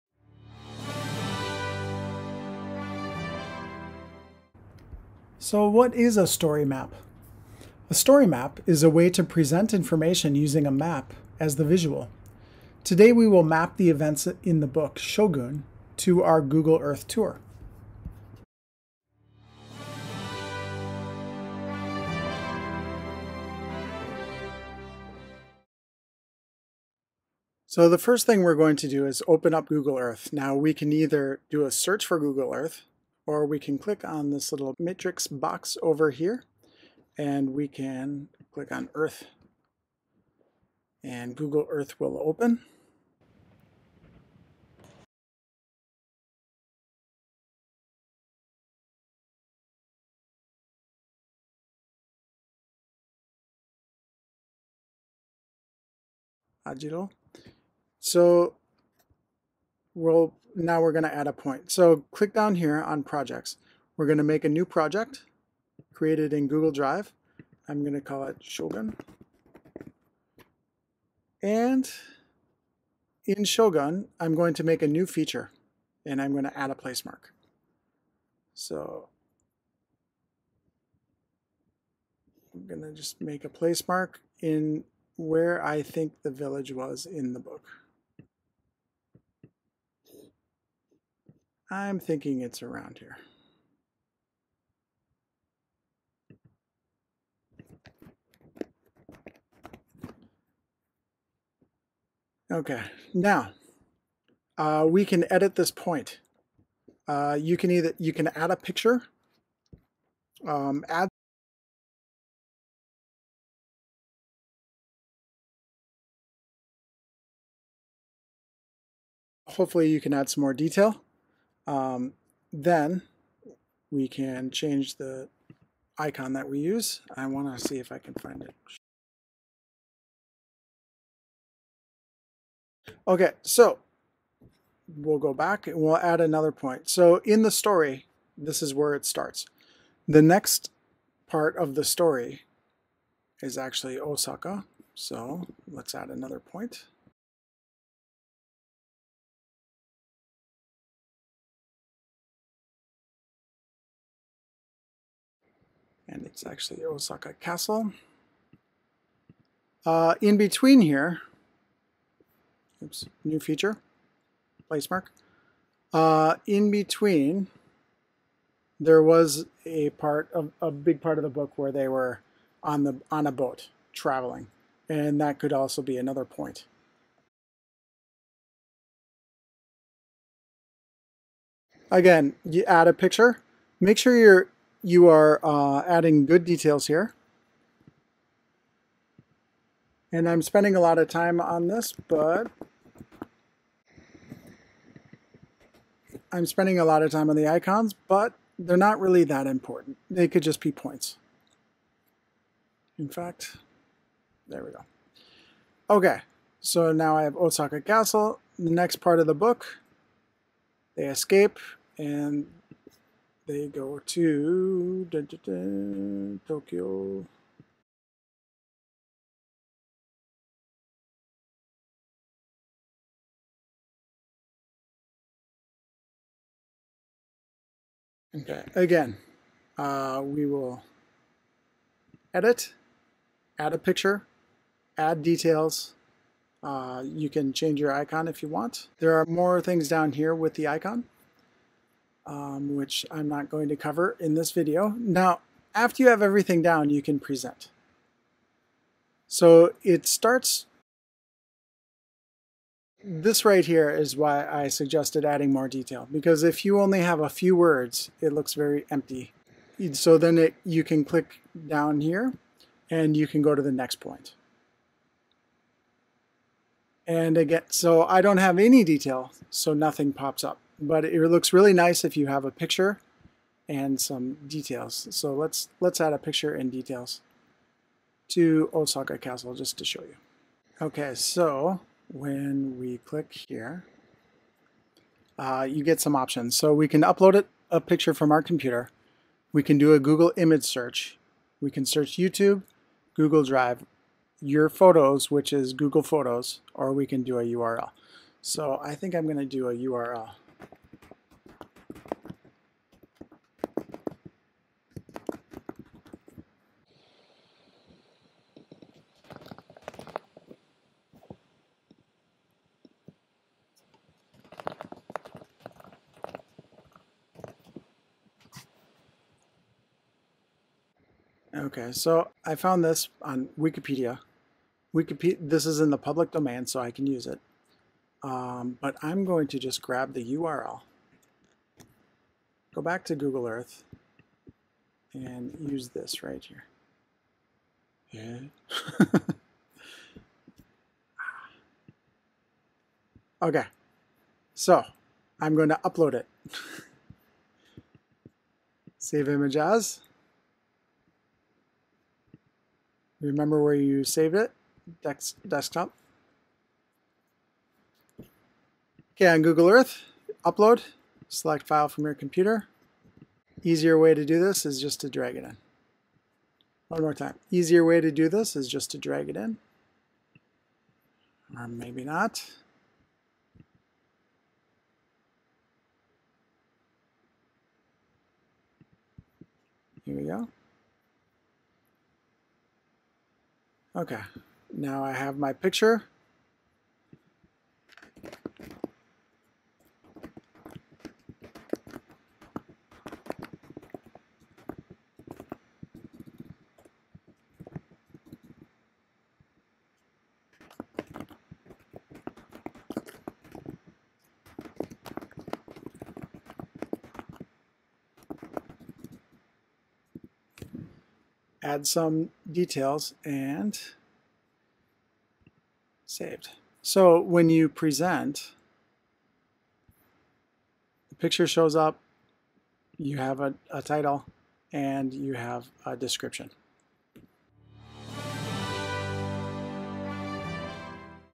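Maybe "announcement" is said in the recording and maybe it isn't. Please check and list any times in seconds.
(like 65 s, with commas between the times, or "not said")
not said.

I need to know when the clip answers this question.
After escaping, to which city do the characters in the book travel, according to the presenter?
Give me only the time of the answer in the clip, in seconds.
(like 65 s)
216 s.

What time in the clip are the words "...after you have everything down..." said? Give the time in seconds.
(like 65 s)
245 s.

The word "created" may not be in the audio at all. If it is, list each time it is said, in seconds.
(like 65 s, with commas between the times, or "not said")
65 s.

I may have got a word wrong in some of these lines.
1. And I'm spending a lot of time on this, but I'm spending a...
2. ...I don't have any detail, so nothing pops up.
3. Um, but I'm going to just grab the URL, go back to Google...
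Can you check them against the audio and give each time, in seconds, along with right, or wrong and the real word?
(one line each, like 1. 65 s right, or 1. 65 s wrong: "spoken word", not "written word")
1. 190 s right
2. 268 s right
3. 328 s right.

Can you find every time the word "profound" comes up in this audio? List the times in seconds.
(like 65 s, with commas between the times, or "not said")
not said.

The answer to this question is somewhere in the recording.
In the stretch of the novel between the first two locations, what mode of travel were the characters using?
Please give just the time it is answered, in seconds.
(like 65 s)
173 s.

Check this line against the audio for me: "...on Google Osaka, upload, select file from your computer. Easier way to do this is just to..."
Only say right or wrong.
wrong.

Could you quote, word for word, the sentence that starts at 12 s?
Today we will map the events in the book Shogun to our Google Earth tour.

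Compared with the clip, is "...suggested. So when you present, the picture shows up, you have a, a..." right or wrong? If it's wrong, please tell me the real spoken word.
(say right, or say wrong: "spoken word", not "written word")
wrong: "saved", not "suggested".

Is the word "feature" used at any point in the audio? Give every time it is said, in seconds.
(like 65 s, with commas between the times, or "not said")
75 s, 163 s.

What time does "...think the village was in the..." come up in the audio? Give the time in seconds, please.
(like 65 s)
85 s.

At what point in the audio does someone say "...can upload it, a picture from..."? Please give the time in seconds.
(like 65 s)
286 s.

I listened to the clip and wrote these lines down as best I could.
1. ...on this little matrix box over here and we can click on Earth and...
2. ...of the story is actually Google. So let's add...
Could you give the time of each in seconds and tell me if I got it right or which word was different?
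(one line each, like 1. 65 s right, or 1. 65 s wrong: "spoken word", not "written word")
1. 34 s right
2. 141 s wrong: "Osaka", not "Google".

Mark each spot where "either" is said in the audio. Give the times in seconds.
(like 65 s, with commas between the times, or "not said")
30 s, 107 s.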